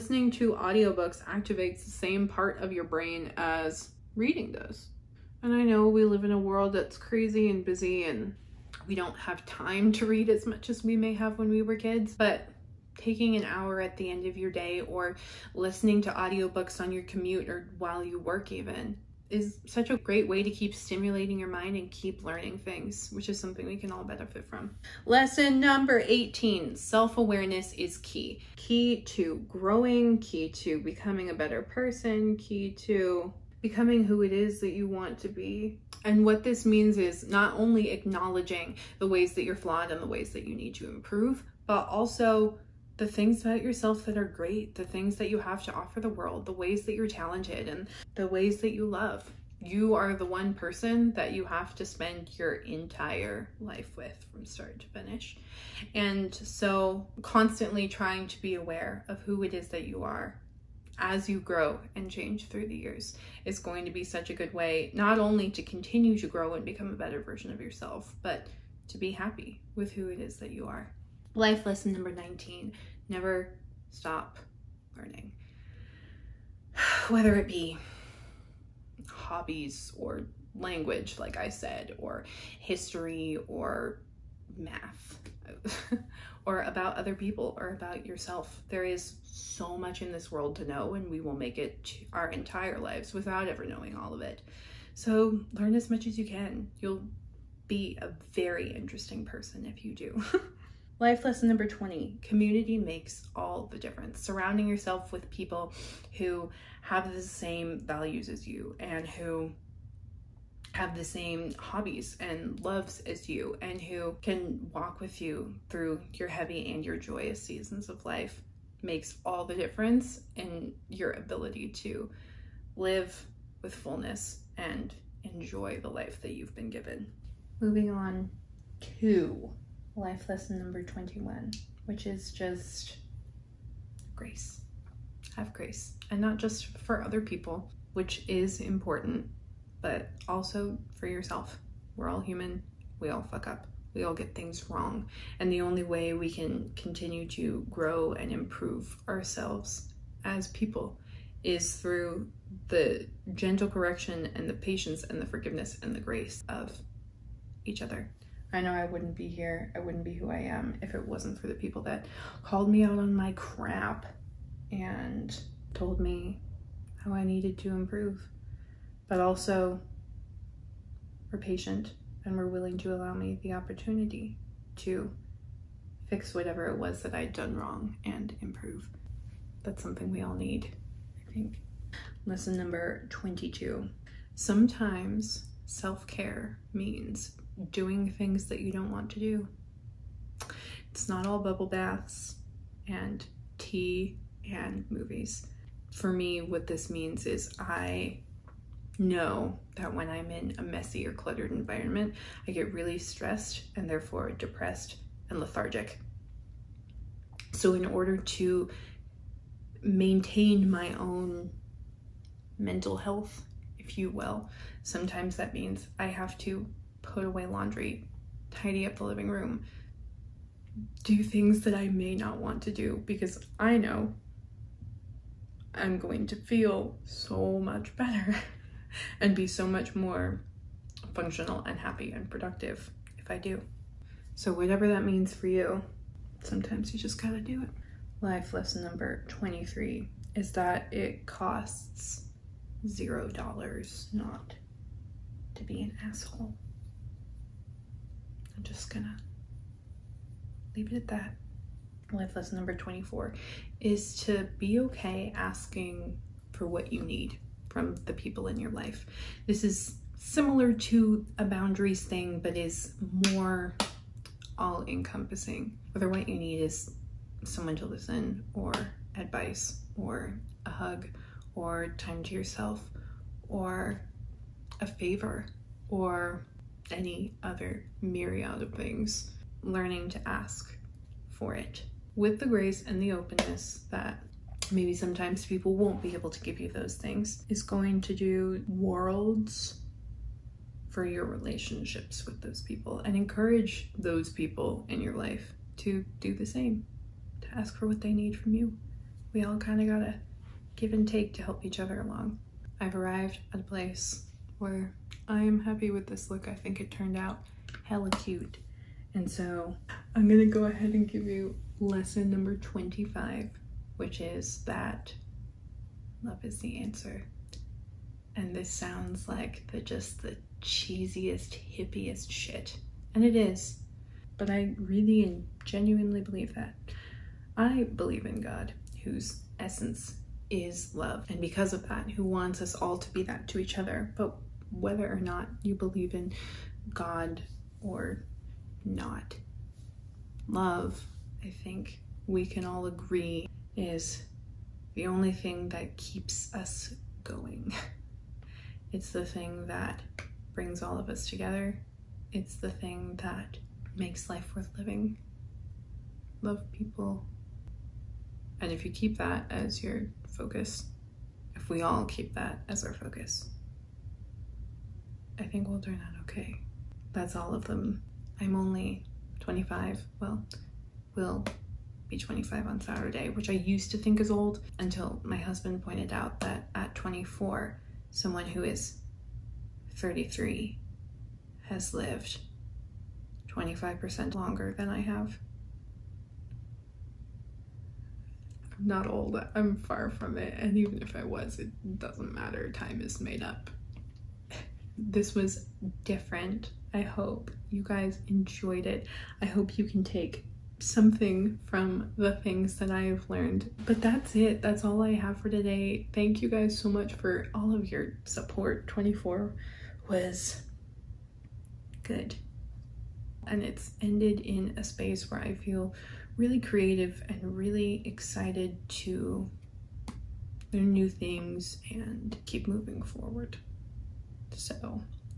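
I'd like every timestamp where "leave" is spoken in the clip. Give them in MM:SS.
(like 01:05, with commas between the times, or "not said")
04:10.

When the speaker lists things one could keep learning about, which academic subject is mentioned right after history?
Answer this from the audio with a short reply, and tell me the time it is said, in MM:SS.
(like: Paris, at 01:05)
Math, at 01:24.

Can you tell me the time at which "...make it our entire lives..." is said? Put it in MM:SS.
01:31.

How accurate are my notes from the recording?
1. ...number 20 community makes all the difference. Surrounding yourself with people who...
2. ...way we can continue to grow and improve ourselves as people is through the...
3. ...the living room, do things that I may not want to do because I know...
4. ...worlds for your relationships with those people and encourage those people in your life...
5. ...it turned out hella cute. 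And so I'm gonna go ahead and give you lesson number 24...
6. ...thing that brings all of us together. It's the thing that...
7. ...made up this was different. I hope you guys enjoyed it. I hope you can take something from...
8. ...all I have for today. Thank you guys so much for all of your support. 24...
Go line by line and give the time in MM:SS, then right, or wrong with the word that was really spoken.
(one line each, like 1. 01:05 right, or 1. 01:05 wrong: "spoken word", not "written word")
1. 01:41 right
2. 02:25 right
3. 03:38 right
4. 04:48 right
5. 05:06 wrong: "25", not "24"
6. 05:49 right
7. 06:33 right
8. 06:44 right.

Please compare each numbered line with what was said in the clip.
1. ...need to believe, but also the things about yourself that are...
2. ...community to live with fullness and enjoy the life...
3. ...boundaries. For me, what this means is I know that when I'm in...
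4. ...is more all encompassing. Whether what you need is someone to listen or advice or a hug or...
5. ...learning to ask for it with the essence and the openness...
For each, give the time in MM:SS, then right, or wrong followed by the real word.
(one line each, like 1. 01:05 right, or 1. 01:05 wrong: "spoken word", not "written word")
1. 00:40 wrong: "improve", not "believe"
2. 02:01 wrong: "ability", not "community"
3. 03:14 wrong: "movies", not "boundaries"
4. 04:22 right
5. 04:39 wrong: "grace", not "essence".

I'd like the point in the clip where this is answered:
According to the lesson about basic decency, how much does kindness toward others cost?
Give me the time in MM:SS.
04:02.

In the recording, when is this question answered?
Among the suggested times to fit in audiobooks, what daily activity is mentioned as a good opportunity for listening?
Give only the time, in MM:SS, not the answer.
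00:17.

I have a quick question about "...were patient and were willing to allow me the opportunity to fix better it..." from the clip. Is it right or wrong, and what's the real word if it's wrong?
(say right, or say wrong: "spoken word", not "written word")
wrong: "whatever", not "better".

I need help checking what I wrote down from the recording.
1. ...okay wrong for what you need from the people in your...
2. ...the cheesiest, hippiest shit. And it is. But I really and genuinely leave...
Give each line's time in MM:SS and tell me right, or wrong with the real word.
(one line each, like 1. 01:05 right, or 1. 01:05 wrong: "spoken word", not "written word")
1. 04:14 wrong: "asking", not "wrong"
2. 05:20 wrong: "believe", not "leave".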